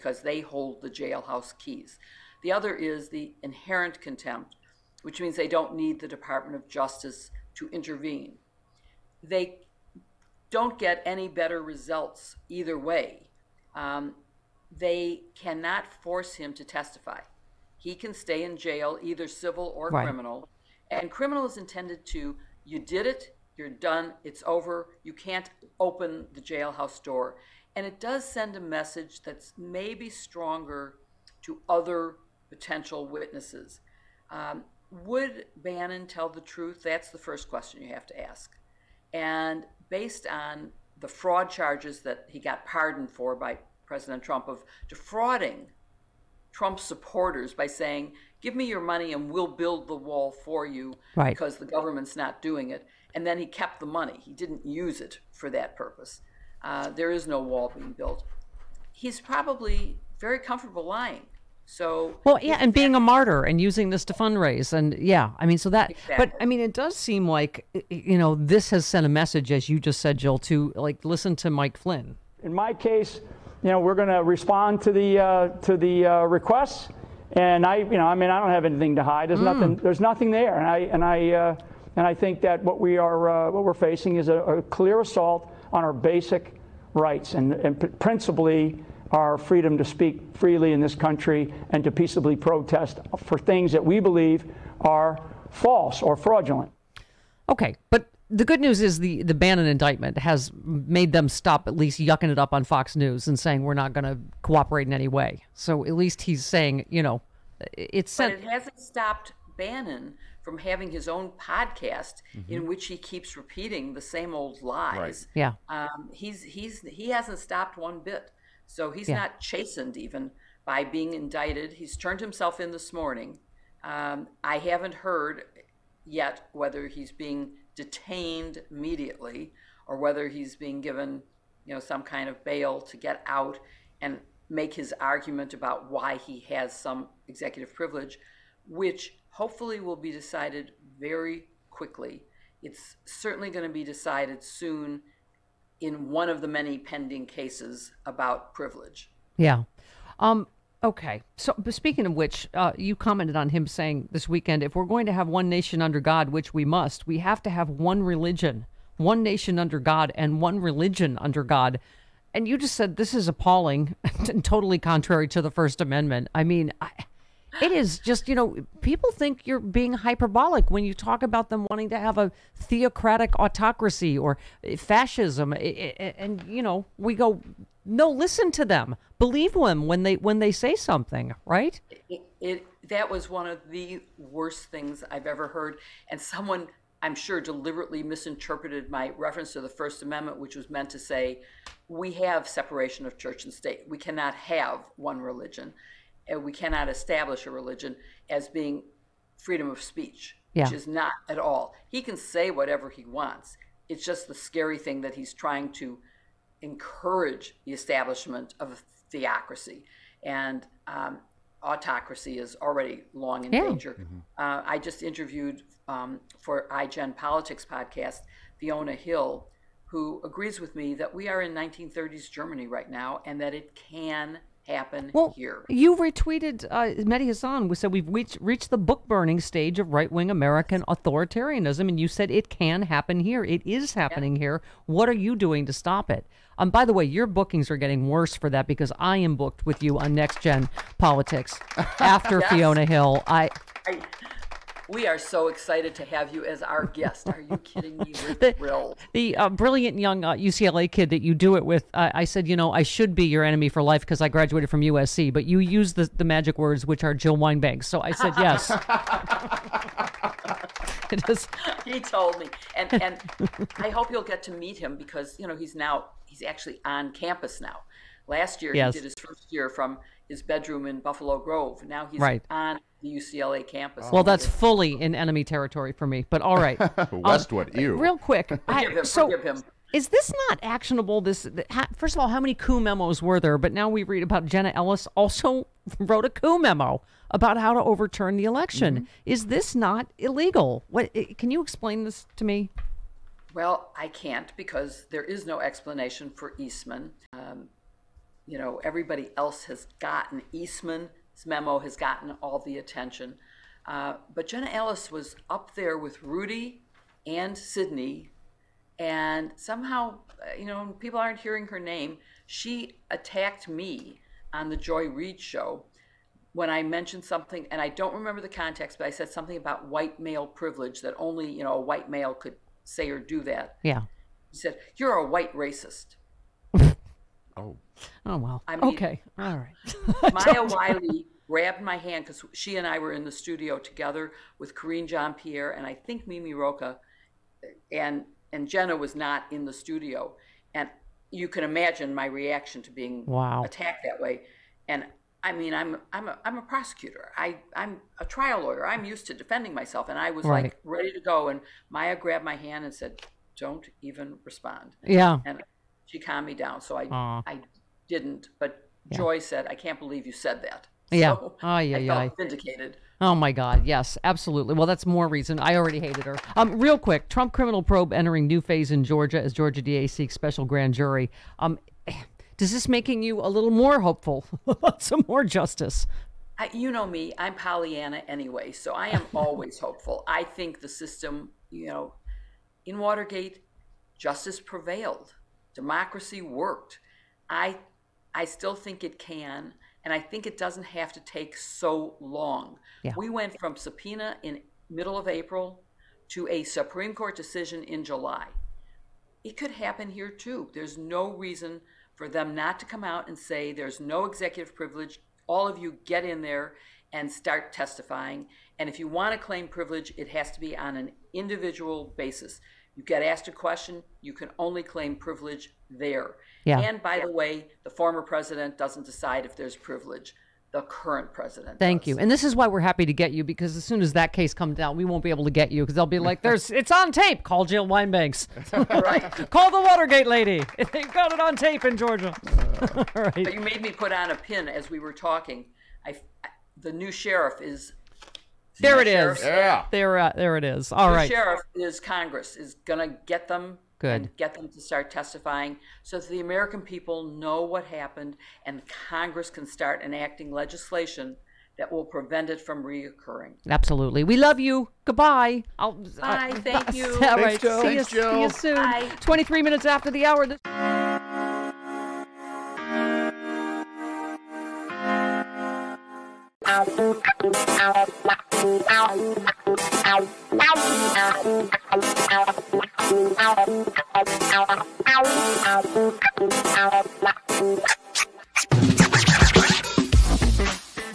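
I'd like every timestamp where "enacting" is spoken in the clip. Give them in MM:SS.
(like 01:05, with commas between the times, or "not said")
07:30.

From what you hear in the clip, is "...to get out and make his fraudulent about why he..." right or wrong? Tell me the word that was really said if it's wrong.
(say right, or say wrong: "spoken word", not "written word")
wrong: "argument", not "fraudulent".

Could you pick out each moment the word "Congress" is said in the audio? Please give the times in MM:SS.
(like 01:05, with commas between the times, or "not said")
07:21, 07:29.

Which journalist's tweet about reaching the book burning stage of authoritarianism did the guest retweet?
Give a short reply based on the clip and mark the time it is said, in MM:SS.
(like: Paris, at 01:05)
Mehdi Hasan, at 03:47.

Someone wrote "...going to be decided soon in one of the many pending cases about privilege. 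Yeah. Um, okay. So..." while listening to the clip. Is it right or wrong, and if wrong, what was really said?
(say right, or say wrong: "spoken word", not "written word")
right.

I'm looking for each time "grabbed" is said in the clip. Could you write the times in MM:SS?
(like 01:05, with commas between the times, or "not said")
05:31, 05:52.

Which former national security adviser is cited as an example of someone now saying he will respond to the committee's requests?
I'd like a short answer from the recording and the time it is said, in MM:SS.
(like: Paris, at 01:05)
Mike Flynn, at 01:11.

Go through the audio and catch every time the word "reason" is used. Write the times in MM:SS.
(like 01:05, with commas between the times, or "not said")
06:05, 06:41.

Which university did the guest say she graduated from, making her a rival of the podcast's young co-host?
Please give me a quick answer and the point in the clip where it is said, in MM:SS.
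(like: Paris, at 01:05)
USC, at 04:14.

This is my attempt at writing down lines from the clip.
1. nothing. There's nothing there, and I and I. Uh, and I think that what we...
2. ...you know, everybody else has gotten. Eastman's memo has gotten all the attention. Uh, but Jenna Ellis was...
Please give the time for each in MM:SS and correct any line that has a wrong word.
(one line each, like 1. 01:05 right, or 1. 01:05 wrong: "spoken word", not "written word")
1. 01:19 right
2. 04:58 right.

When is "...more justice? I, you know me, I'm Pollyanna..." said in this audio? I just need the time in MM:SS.
06:15.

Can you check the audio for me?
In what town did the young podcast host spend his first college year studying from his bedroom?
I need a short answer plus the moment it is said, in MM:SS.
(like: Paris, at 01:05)
Buffalo Grove, at 04:31.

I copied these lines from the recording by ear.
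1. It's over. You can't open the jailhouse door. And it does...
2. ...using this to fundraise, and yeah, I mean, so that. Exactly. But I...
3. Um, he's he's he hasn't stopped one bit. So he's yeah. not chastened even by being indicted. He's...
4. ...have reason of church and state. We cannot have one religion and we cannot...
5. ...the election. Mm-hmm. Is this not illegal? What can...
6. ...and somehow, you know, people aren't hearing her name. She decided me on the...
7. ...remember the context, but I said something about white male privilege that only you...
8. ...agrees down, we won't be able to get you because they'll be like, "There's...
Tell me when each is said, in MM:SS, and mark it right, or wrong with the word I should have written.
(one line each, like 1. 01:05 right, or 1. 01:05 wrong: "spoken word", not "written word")
1. 00:24 right
2. 01:03 right
3. 01:55 right
4. 03:12 wrong: "separation", not "reason"
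5. 04:48 right
6. 05:08 wrong: "attacked", not "decided"
7. 05:18 right
8. 07:04 wrong: "comes", not "agrees".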